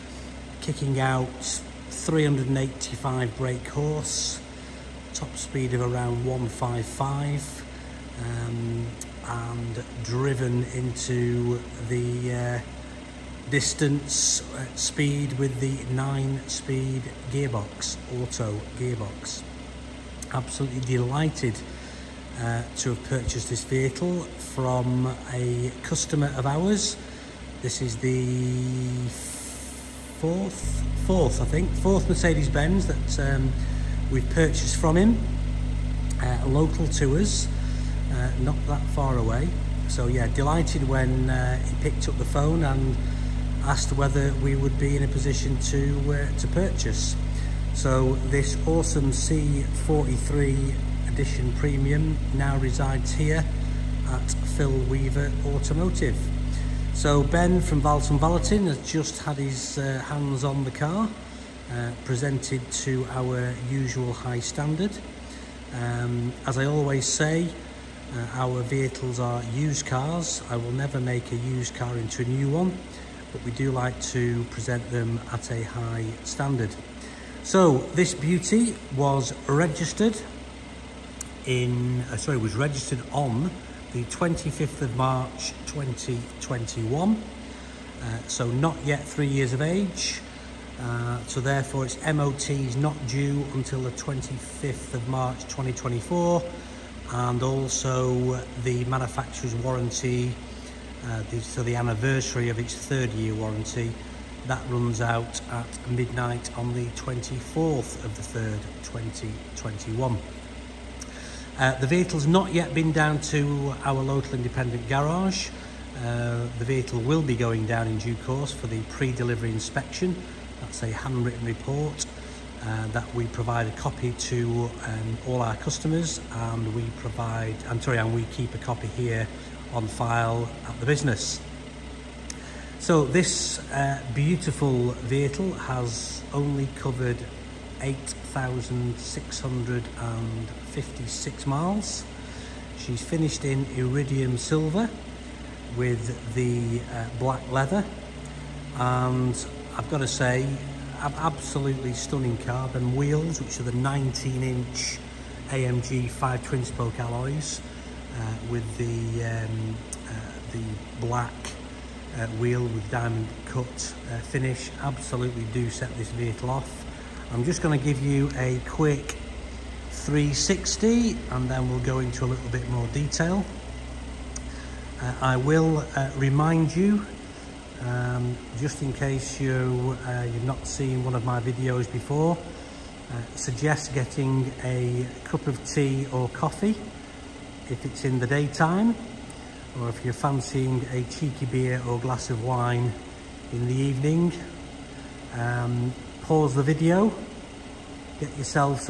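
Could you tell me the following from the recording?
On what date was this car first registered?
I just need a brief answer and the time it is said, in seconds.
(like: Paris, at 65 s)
25th of March 2021, at 84 s.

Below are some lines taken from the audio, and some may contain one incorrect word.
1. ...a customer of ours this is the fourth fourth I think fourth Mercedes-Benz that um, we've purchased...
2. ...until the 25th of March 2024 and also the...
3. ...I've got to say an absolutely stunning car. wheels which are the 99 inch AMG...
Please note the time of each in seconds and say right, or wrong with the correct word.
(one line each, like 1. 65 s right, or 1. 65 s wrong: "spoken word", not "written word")
1. 25 s right
2. 93 s right
3. 149 s wrong: "19", not "99".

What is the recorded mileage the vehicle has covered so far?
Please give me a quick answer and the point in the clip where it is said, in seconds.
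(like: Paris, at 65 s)
8,656 miles, at 137 s.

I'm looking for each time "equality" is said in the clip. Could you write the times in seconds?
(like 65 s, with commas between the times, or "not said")
not said.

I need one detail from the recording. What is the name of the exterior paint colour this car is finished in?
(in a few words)
Iridium silver.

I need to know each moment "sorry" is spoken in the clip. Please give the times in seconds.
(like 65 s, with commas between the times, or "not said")
82 s, 127 s.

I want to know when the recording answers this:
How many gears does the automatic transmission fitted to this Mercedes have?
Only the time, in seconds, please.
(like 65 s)
15 s.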